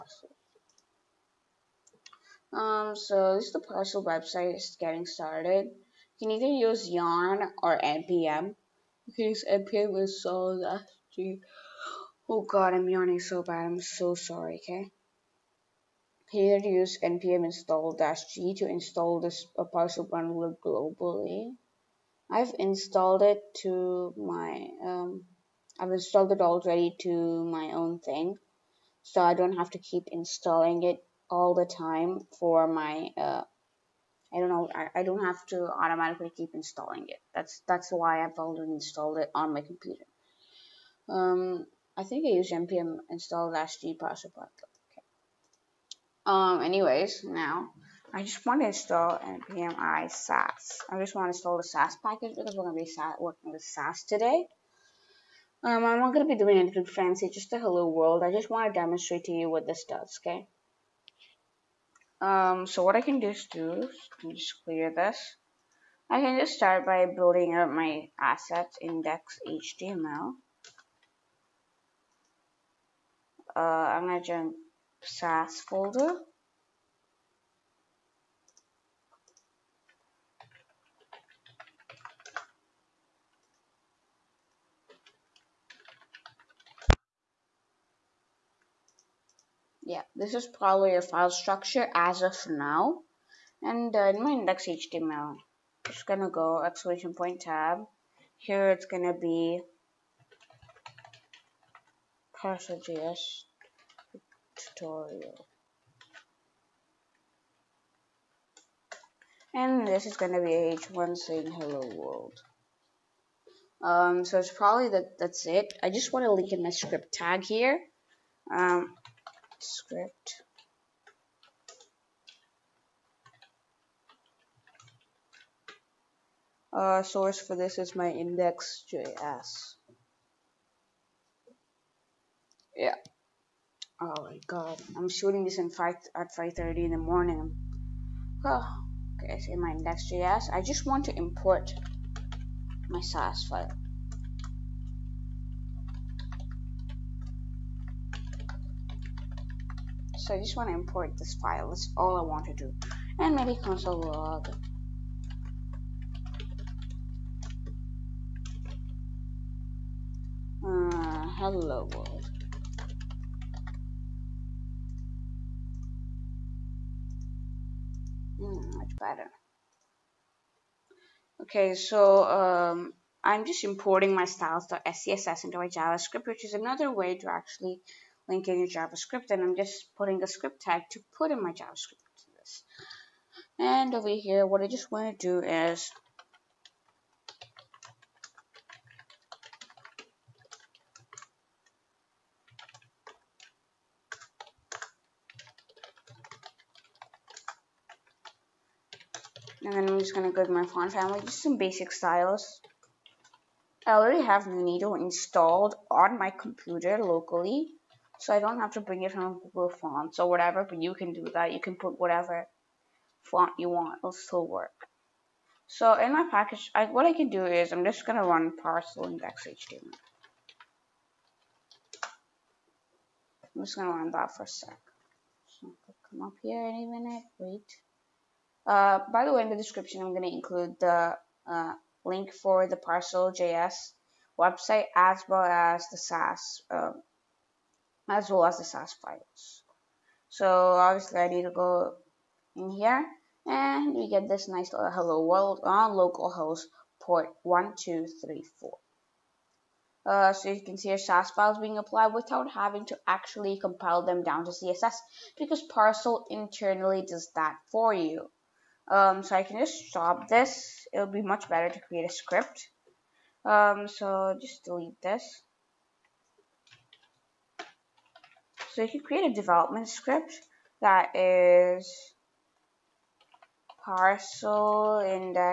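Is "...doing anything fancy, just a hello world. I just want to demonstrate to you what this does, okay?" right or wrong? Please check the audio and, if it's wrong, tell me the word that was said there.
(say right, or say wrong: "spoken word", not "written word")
right.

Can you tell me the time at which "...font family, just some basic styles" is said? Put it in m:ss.
3:20.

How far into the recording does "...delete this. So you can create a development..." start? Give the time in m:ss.
4:24.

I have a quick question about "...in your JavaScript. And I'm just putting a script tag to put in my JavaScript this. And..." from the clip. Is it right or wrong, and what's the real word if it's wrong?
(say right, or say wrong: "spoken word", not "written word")
right.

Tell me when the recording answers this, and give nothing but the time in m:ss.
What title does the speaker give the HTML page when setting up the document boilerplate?
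1:42.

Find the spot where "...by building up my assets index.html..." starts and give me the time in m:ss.
1:06.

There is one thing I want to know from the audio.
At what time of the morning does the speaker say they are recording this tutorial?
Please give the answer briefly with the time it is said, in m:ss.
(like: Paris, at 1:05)
5:30, at 2:16.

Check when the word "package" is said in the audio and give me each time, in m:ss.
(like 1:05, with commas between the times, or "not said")
0:52, 3:36.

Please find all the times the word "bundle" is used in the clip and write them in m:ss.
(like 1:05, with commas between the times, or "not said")
0:20.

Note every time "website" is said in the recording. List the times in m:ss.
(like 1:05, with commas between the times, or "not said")
0:04, 3:54.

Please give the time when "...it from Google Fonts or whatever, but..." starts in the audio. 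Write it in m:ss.
3:29.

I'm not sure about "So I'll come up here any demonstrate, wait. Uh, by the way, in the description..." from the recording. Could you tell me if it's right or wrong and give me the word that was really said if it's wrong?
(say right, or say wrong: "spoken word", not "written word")
wrong: "minute", not "demonstrate".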